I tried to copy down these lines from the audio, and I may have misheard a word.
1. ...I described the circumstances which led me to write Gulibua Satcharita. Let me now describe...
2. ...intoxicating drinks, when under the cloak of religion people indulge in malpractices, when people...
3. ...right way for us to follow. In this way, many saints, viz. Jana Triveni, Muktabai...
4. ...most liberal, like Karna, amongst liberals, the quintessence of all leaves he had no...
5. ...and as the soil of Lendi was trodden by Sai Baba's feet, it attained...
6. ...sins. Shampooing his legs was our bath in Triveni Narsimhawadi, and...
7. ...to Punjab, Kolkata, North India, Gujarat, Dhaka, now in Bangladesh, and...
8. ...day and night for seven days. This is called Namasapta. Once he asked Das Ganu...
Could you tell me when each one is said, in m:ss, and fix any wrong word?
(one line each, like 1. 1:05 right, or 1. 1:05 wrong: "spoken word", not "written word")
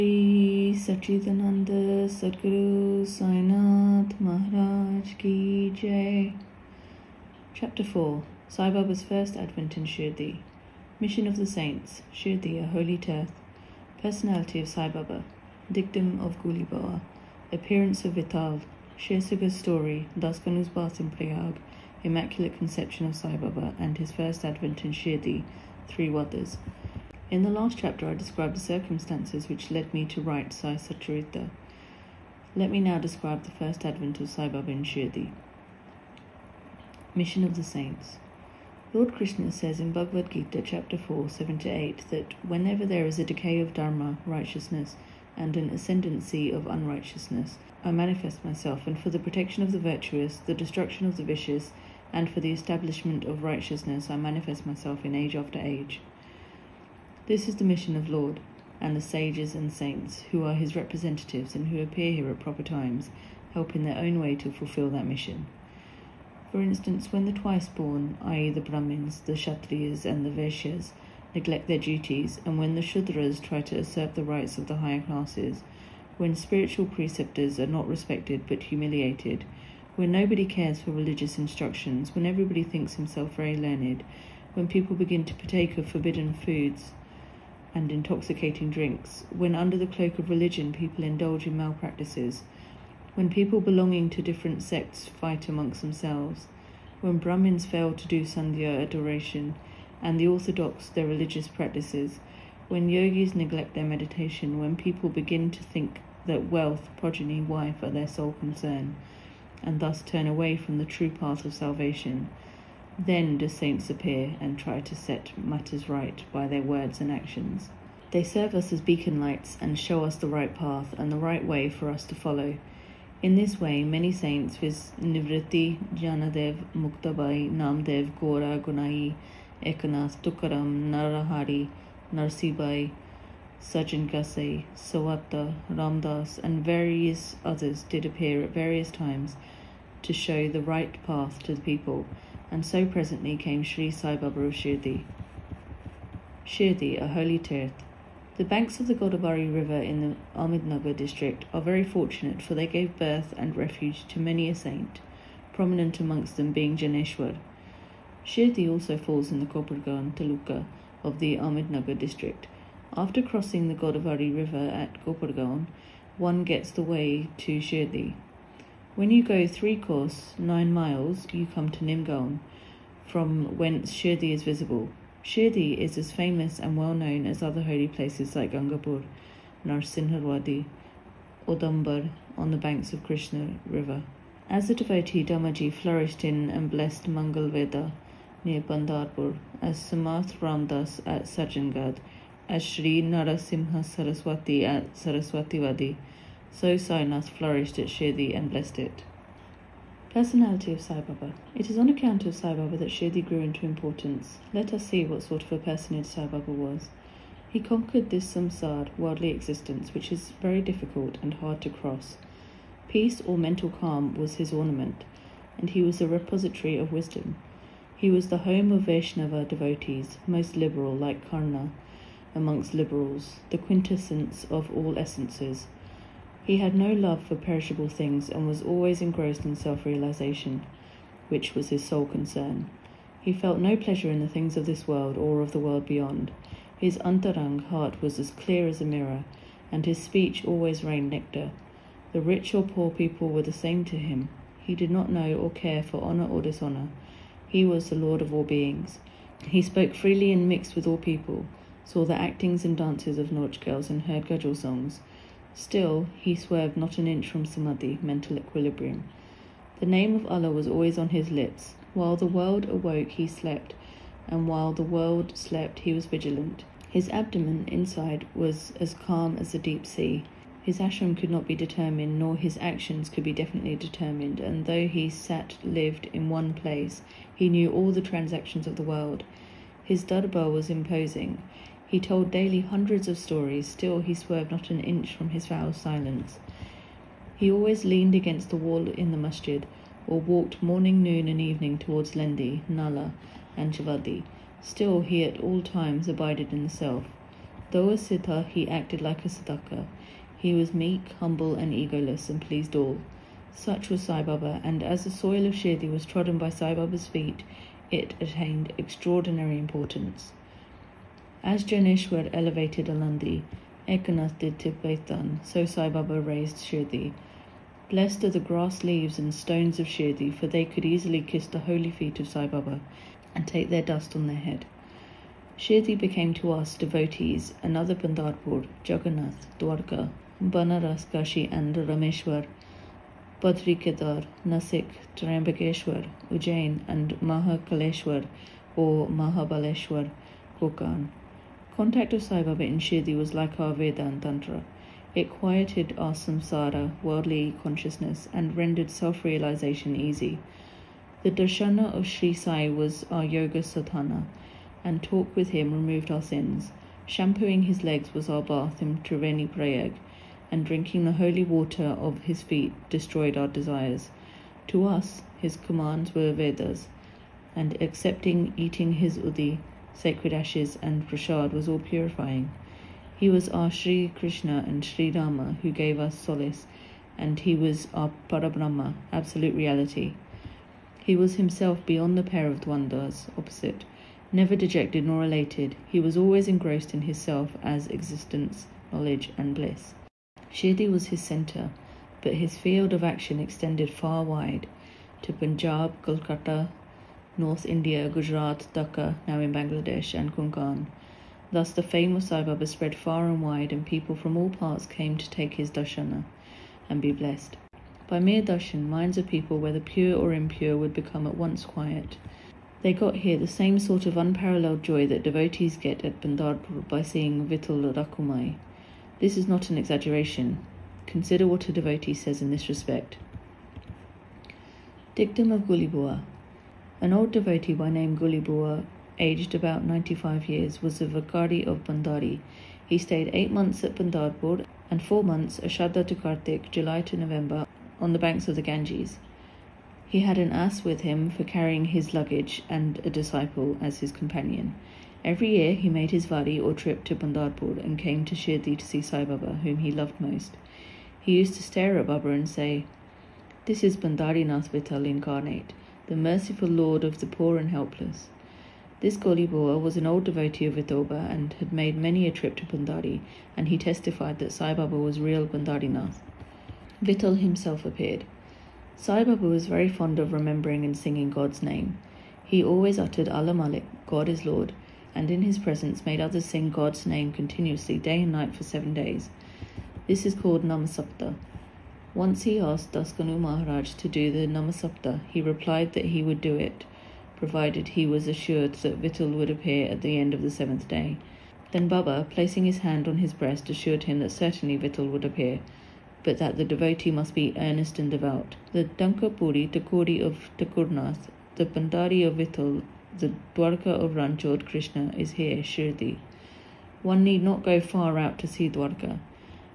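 1. 0:28 wrong: "Sai", not "Gulibua"
2. 1:27 right
3. 2:01 wrong: "Janadev", not "Triveni"
4. 3:40 wrong: "essences", not "leaves"
5. 5:04 wrong: "Shirdi", not "Lendi"
6. 5:56 wrong: "Prayag", not "Narsimhawadi"
7. 6:35 right
8. 7:57 right.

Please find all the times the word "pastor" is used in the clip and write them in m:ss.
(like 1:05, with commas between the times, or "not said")
not said.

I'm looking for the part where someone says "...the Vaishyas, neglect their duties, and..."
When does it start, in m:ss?
1:10.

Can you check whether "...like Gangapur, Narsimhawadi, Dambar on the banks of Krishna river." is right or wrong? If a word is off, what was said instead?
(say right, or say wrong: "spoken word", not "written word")
right.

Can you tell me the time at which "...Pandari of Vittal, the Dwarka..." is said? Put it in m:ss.
8:21.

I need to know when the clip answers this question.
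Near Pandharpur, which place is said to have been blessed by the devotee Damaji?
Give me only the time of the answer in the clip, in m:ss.
3:07.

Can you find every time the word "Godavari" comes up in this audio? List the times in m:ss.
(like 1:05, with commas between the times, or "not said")
2:28, 2:43.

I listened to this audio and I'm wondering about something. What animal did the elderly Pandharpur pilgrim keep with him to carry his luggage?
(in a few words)
An ass.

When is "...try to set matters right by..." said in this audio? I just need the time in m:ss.
1:54.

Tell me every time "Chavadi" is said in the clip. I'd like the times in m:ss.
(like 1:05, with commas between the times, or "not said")
4:53.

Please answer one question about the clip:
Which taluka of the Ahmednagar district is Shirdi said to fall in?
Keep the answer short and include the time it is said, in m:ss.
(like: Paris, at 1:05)
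Kopargaon taluka, at 2:39.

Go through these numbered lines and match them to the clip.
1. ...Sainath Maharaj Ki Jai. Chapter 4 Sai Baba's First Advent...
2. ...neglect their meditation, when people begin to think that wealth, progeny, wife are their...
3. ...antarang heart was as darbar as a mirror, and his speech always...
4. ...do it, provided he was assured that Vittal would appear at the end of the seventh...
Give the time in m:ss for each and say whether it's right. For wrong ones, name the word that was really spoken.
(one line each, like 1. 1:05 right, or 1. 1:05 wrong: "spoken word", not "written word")
1. 0:03 right
2. 1:43 right
3. 3:56 wrong: "clear", not "darbar"
4. 8:06 right.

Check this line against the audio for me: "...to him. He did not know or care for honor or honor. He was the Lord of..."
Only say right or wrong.
wrong.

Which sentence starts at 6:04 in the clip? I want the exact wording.
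To us, his commands were Vedas, and accepting eating his udi sacred ashes, and prasad was all purifying.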